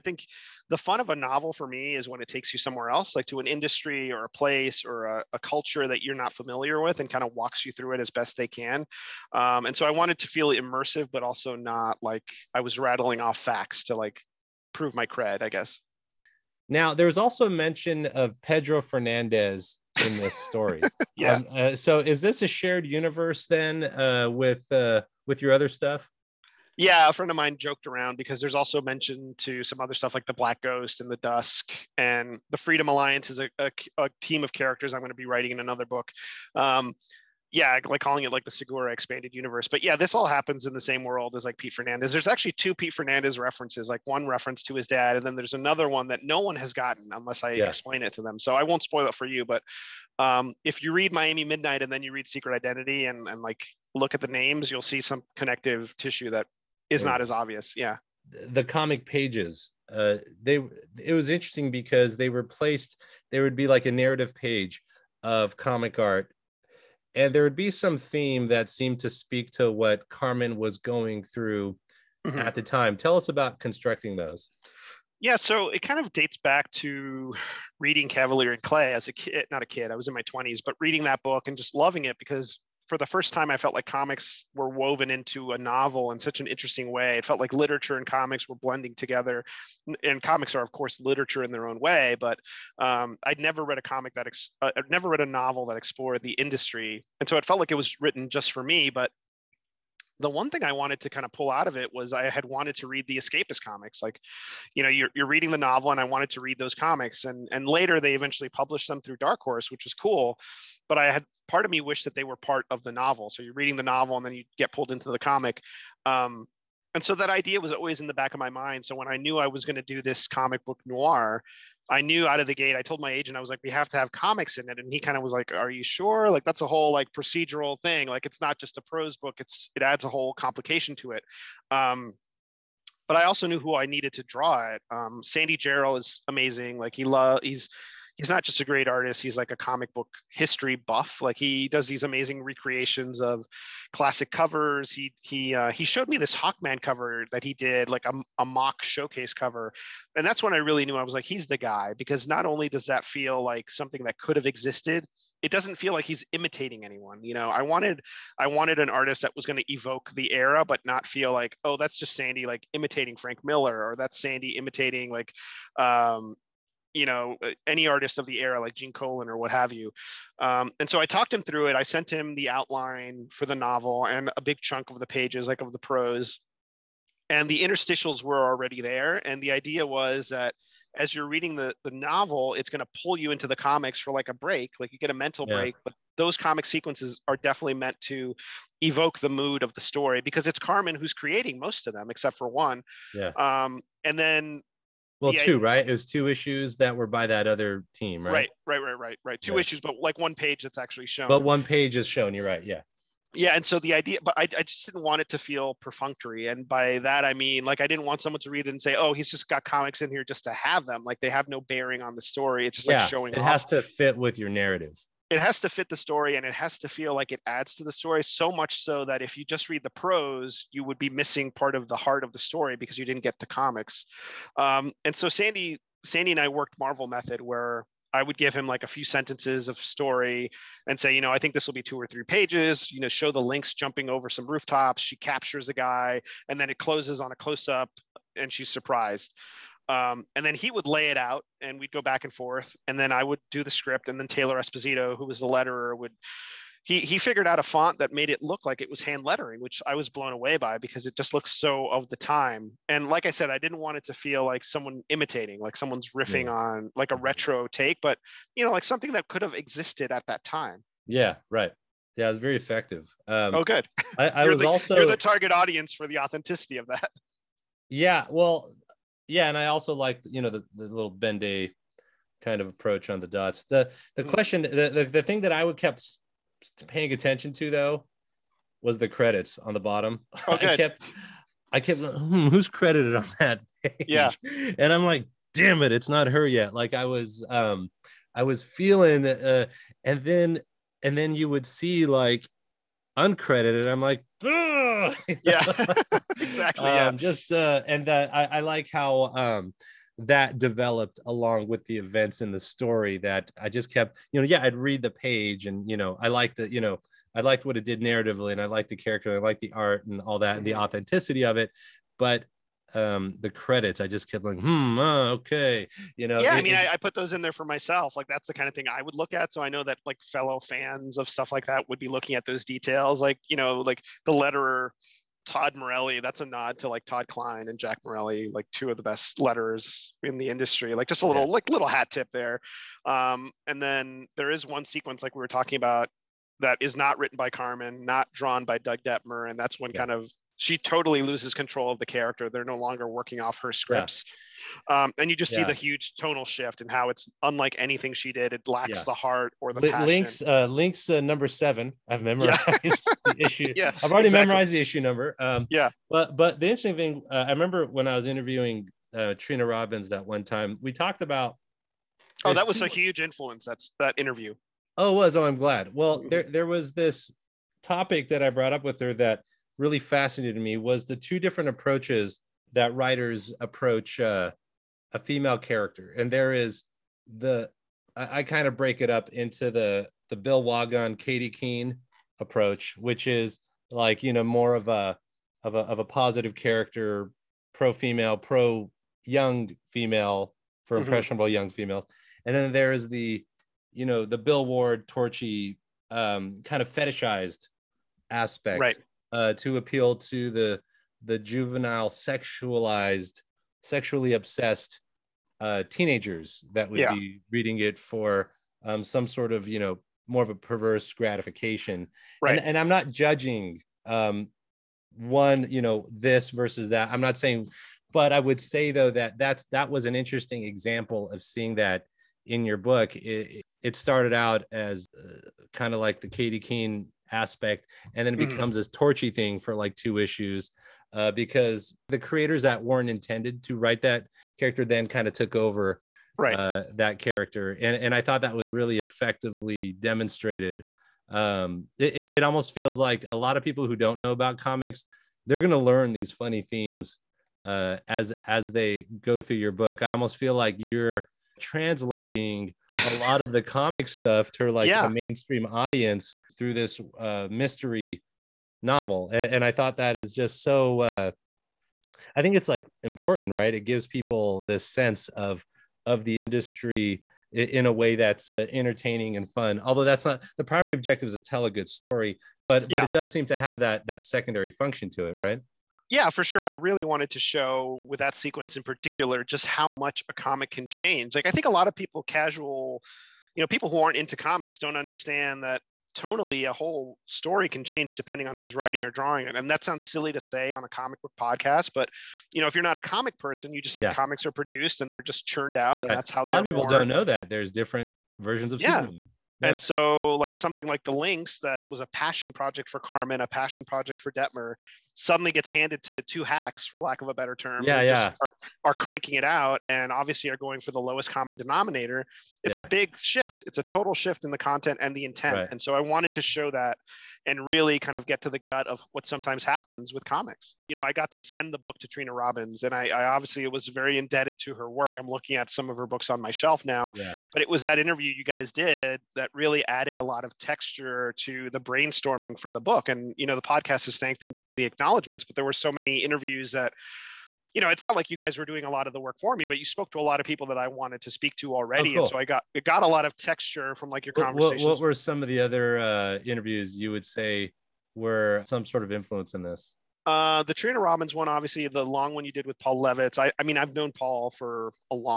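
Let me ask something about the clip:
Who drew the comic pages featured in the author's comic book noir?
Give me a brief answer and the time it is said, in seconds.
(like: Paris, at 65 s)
Sandy Jarrell, at 135 s.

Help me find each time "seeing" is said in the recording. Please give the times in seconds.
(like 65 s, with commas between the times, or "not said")
421 s.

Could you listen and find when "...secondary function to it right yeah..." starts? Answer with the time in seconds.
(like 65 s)
474 s.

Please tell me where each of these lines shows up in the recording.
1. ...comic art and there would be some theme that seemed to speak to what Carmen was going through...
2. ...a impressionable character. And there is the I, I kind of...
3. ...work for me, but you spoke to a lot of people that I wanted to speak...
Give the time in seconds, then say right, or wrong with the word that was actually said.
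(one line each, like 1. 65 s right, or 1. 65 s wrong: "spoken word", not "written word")
1. 65 s right
2. 375 s wrong: "female", not "impressionable"
3. 539 s right.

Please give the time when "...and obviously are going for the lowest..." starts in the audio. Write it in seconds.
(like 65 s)
509 s.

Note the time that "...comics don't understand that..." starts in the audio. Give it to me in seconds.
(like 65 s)
484 s.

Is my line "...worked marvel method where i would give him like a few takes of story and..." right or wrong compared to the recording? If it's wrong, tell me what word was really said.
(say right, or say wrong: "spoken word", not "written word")
wrong: "sentences", not "takes".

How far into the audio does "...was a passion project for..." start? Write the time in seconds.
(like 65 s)
501 s.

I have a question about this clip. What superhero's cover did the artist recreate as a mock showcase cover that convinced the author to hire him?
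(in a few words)
Hawkman.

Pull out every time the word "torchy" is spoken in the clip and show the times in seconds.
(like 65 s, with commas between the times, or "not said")
395 s, 428 s.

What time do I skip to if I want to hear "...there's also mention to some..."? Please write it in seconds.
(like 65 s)
28 s.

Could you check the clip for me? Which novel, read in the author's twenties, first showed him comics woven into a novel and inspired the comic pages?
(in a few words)
Cavalier and Clay.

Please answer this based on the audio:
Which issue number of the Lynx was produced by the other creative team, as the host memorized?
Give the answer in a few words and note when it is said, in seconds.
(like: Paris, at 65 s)
7, at 351 s.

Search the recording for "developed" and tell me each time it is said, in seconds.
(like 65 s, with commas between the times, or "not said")
300 s.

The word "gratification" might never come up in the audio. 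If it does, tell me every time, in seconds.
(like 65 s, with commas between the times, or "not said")
411 s.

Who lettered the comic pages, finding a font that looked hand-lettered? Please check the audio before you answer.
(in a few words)
Taylor Esposito.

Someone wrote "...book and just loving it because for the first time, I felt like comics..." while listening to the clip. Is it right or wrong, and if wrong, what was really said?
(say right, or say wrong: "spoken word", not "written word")
right.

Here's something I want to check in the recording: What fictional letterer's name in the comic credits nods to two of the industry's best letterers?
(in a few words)
Todd Morelli.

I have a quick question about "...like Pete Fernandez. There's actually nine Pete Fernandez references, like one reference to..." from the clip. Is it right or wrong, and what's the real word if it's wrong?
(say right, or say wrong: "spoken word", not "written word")
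wrong: "two", not "nine".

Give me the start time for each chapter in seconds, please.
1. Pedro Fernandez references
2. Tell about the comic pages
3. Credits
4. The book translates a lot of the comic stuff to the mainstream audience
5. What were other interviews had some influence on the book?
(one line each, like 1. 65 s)
1. 16 s
2. 57 s
3. 272 s
4. 350 s
5. 520 s.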